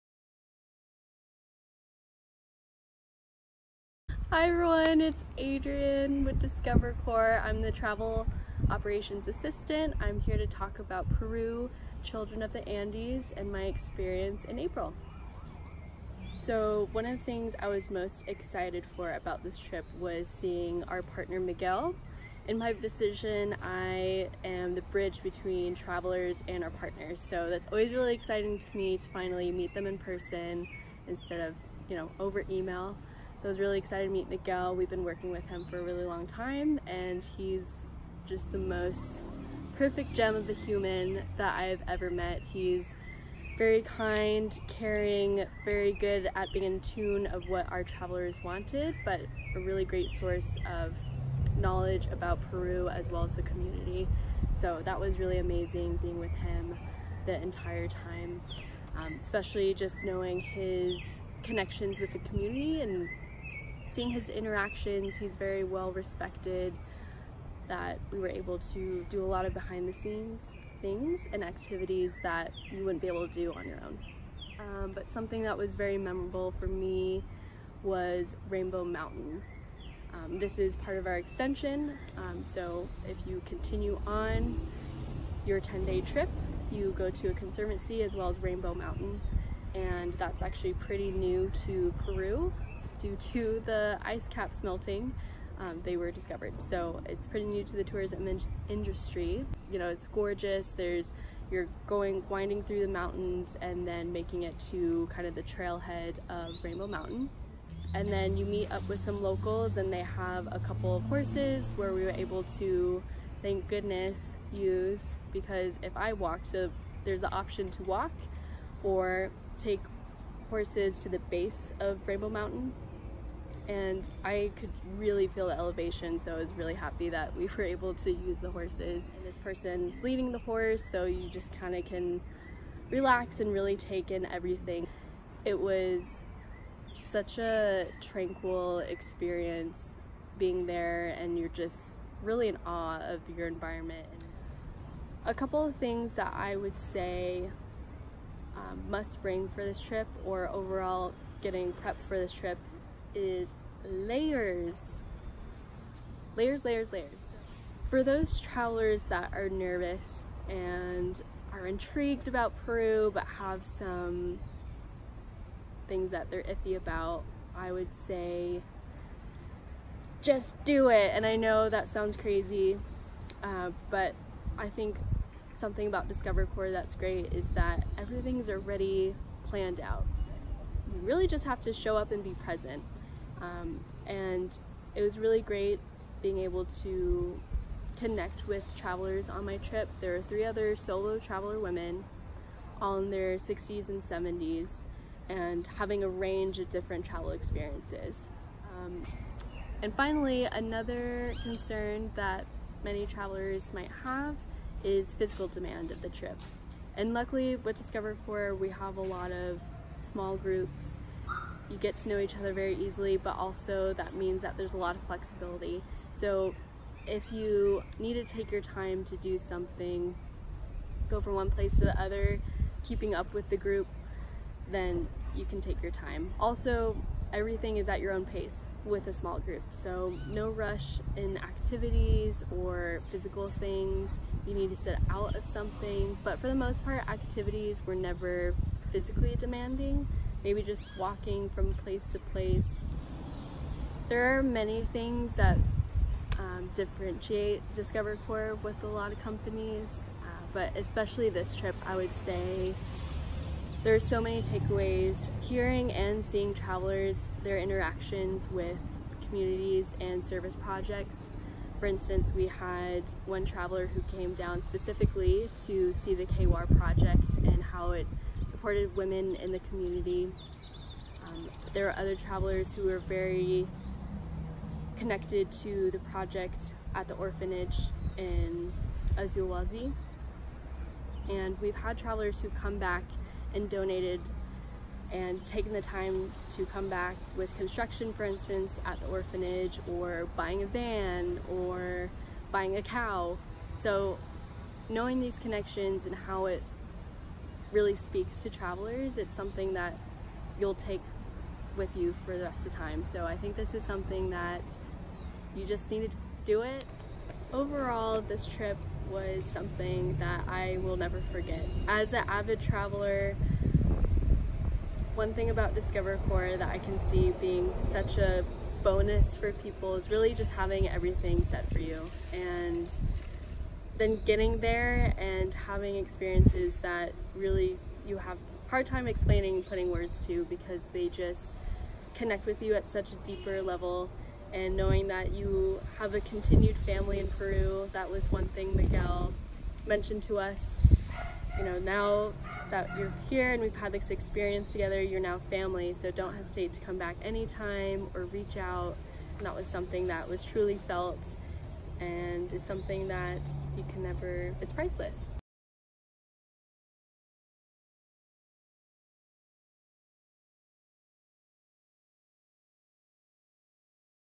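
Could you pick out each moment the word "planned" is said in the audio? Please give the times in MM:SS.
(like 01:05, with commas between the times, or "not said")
02:59.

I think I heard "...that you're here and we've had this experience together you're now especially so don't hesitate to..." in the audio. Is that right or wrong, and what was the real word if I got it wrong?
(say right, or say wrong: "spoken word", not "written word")
wrong: "family", not "especially".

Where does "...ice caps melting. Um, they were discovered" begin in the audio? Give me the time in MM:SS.
01:34.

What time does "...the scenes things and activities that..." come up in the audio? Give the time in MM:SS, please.
01:09.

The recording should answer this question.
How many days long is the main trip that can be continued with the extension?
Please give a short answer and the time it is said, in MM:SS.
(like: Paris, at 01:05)
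10, at 01:25.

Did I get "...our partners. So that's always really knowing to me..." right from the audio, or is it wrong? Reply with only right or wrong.
wrong.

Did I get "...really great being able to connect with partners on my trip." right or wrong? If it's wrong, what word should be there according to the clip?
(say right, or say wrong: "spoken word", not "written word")
wrong: "travelers", not "partners".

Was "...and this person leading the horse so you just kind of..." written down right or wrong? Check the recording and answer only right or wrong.
right.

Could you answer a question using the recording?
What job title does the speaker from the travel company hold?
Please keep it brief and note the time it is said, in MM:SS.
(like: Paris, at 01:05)
Travel Operations Assistant, at 00:07.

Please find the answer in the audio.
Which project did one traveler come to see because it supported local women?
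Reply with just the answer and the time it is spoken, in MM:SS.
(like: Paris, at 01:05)
KWAR project, at 04:26.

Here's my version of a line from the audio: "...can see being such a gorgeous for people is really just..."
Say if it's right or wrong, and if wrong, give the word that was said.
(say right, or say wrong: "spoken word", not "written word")
wrong: "bonus", not "gorgeous".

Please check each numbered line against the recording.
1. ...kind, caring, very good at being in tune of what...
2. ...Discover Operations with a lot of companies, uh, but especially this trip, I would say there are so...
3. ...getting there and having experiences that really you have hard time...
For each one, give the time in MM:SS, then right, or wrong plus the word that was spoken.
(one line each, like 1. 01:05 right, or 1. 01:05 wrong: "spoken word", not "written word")
1. 00:43 right
2. 04:07 wrong: "Corps", not "Operations"
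3. 05:24 right.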